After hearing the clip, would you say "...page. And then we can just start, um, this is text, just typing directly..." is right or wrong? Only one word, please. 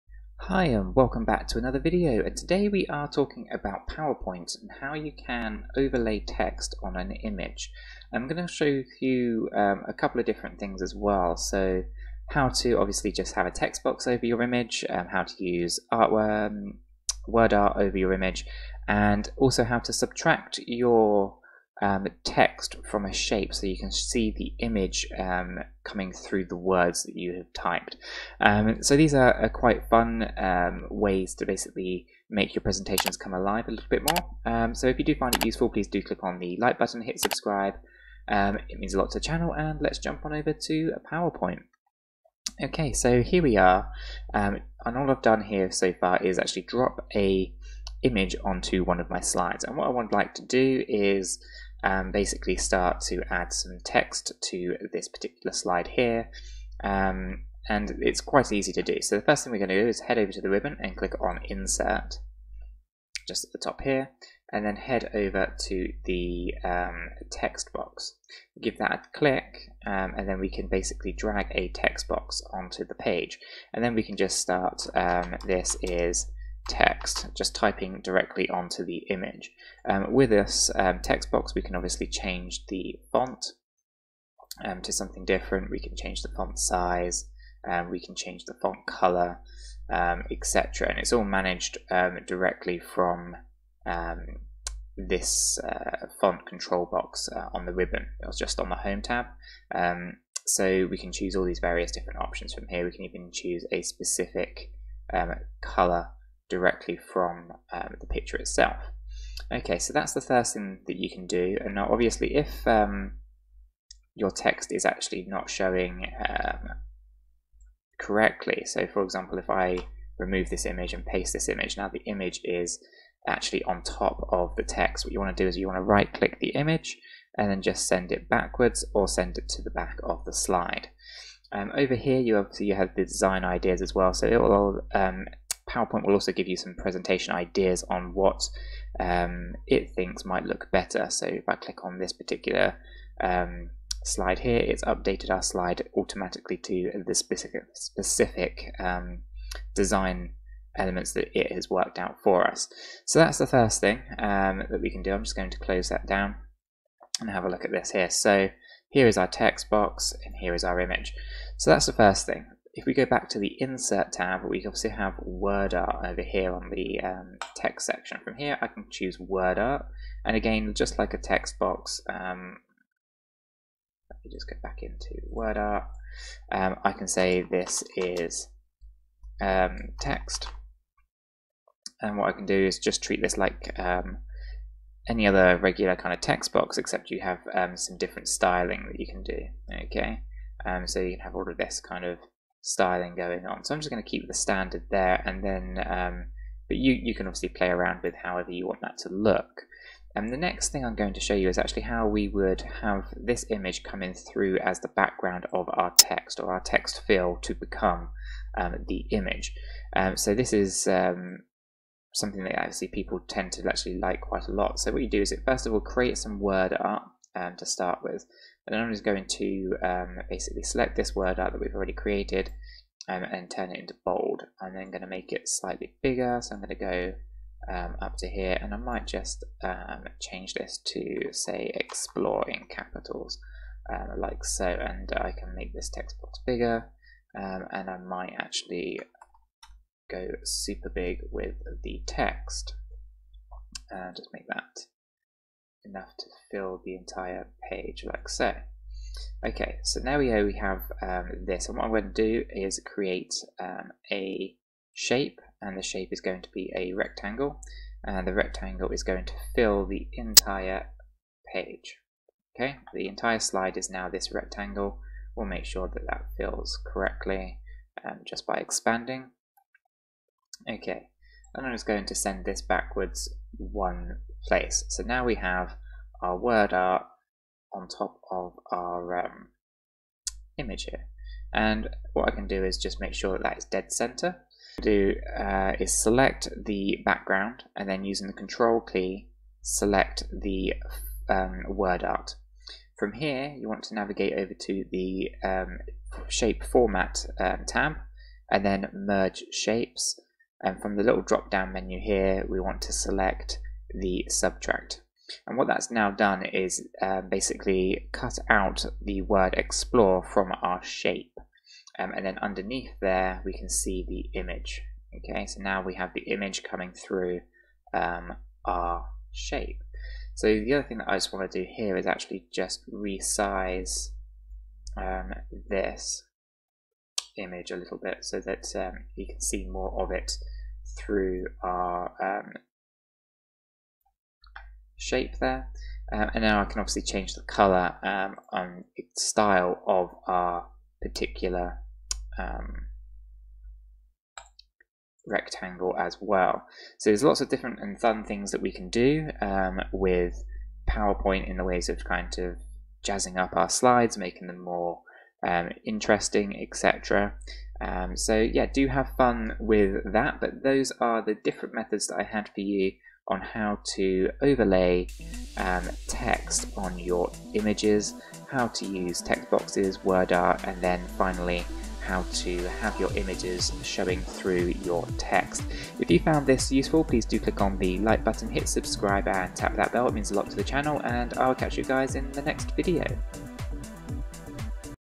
right.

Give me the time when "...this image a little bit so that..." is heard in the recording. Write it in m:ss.
5:25.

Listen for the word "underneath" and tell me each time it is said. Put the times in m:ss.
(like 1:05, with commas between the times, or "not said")
5:12.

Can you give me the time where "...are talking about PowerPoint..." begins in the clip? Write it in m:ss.
0:02.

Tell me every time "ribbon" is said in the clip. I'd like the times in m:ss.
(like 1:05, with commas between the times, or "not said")
1:00, 1:37.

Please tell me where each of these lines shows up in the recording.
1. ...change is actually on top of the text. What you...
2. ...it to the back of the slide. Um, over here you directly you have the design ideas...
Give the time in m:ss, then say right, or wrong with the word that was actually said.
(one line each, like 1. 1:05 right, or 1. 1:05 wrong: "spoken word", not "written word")
1. 2:02 wrong: "image", not "change"
2. 2:09 wrong: "obviously", not "directly".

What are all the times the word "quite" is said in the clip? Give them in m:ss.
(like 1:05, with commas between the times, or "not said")
0:29, 0:58, 3:34.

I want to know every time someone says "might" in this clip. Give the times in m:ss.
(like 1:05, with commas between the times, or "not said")
2:20, 3:48, 3:57.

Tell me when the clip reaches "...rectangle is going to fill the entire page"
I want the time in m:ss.
4:18.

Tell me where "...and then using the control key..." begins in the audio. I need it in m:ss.
4:47.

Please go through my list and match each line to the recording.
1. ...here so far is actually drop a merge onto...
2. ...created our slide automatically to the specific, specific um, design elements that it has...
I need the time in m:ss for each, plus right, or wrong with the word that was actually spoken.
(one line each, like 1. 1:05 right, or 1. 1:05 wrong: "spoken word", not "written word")
1. 0:45 wrong: "image", not "merge"
2. 2:24 wrong: "updated", not "created".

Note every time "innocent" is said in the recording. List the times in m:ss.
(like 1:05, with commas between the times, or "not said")
not said.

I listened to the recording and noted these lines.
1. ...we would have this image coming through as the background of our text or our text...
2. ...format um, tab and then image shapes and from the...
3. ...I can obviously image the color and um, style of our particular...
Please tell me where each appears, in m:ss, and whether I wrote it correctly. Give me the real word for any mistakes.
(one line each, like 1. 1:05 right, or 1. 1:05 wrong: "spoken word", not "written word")
1. 3:22 right
2. 4:56 wrong: "merge", not "image"
3. 5:36 wrong: "change", not "image".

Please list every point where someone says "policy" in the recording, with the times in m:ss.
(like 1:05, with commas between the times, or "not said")
not said.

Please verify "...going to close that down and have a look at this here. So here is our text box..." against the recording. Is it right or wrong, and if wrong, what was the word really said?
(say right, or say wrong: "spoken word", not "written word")
right.